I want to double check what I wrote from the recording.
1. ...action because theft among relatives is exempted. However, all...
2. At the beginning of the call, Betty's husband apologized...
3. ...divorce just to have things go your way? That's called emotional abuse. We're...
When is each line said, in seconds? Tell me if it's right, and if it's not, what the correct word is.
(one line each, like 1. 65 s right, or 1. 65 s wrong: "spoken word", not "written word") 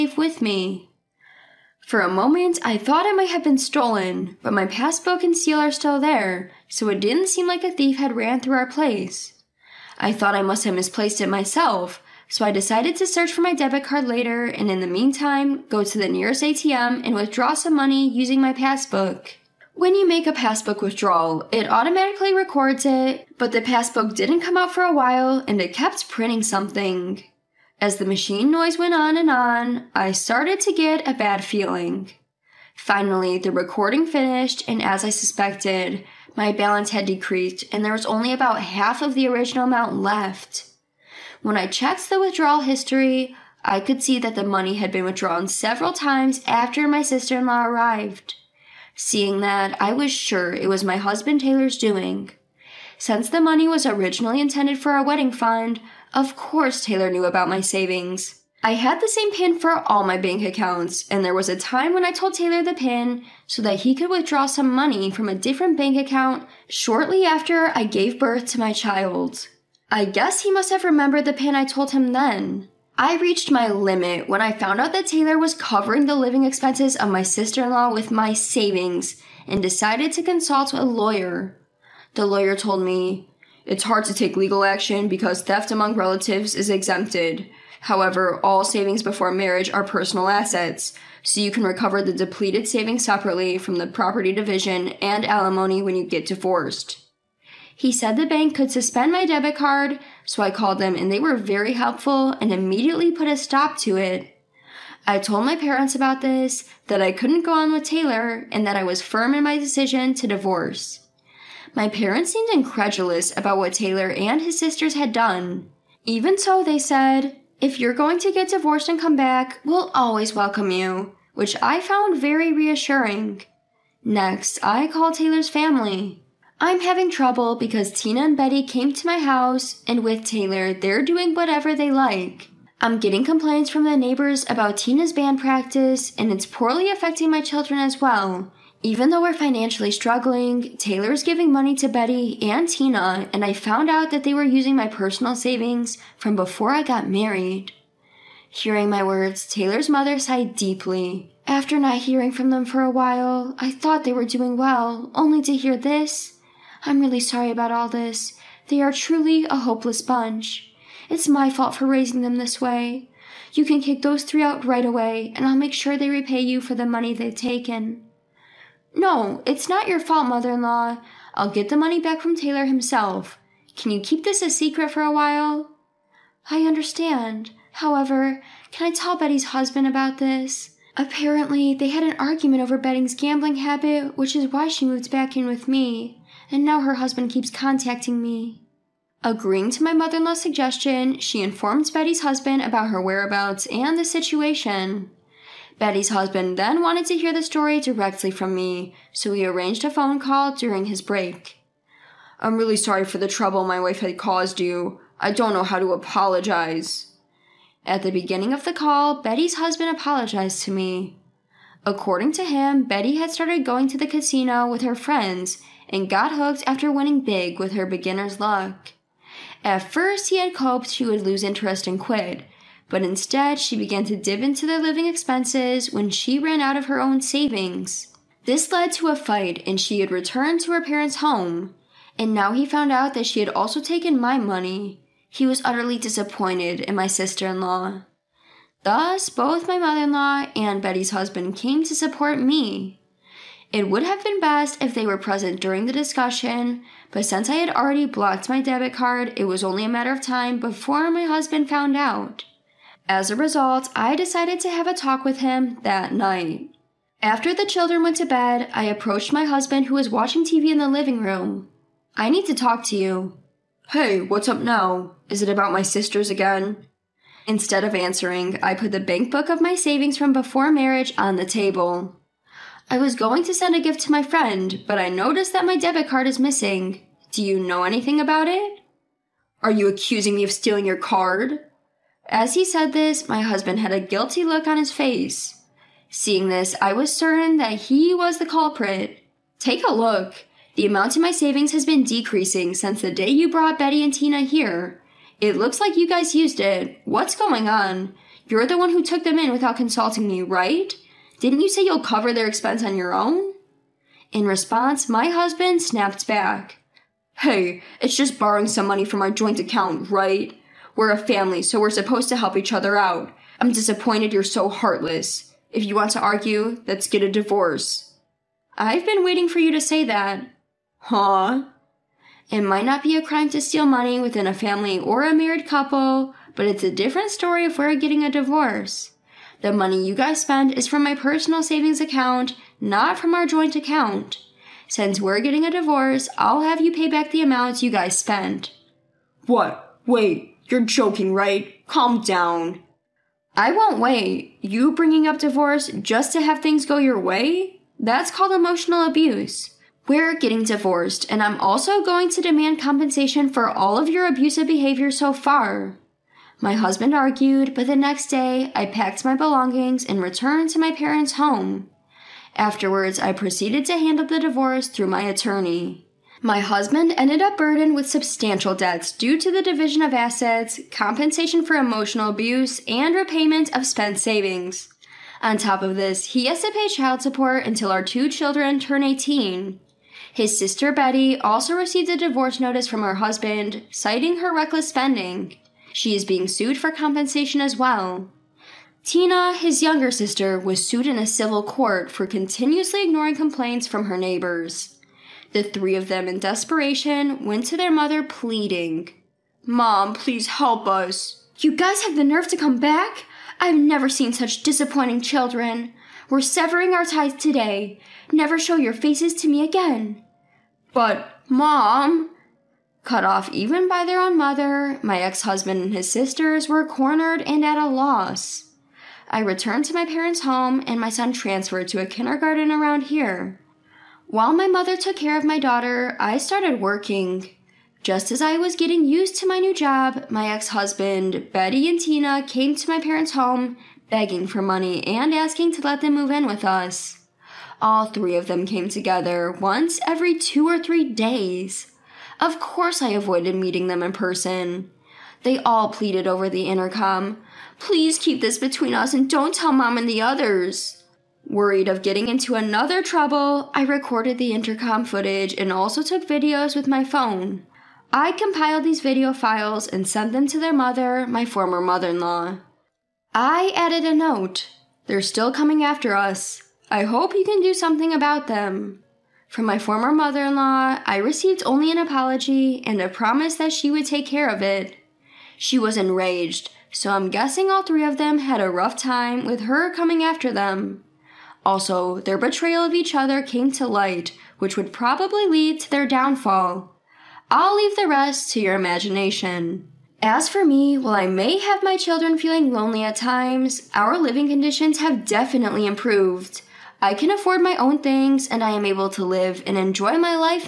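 1. 84 s right
2. 207 s right
3. 345 s right.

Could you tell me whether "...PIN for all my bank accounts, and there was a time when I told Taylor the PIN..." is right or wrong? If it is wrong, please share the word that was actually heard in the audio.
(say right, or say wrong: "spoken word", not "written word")
right.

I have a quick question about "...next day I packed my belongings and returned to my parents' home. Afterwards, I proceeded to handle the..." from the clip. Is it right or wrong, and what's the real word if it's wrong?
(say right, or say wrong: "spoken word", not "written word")
right.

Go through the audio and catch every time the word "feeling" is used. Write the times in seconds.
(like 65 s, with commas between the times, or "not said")
31 s, 492 s.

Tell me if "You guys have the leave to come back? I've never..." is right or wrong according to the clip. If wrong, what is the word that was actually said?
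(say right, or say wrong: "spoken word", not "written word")
wrong: "nerve", not "leave".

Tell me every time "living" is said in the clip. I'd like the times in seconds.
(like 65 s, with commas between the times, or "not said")
76 s, 224 s, 260 s, 494 s.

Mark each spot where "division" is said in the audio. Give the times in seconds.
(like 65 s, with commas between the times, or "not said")
94 s, 369 s.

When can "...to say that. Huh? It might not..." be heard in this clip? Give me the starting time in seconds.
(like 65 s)
319 s.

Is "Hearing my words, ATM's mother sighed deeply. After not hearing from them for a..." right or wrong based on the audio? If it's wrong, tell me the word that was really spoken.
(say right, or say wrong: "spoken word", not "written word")
wrong: "Taylor", not "ATM".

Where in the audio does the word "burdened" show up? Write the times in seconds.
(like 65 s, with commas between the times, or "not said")
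367 s.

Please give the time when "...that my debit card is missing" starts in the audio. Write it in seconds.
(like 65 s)
275 s.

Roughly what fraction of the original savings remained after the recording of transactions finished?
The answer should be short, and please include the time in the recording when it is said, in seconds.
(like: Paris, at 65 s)
half, at 38 s.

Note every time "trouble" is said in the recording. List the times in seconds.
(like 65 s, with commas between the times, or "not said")
127 s, 203 s, 453 s.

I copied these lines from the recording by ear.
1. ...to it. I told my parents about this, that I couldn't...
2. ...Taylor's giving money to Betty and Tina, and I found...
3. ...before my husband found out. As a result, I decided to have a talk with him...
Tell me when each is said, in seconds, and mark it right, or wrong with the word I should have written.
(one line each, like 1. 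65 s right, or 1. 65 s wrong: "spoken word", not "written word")
1. 103 s right
2. 140 s right
3. 250 s right.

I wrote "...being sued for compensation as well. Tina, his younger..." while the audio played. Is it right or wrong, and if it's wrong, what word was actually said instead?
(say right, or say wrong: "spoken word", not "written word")
right.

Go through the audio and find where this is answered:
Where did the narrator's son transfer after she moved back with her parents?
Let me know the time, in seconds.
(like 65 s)
422 s.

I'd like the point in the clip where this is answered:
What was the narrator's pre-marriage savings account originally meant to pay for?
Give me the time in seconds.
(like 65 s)
55 s.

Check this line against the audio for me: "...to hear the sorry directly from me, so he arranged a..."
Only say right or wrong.
wrong.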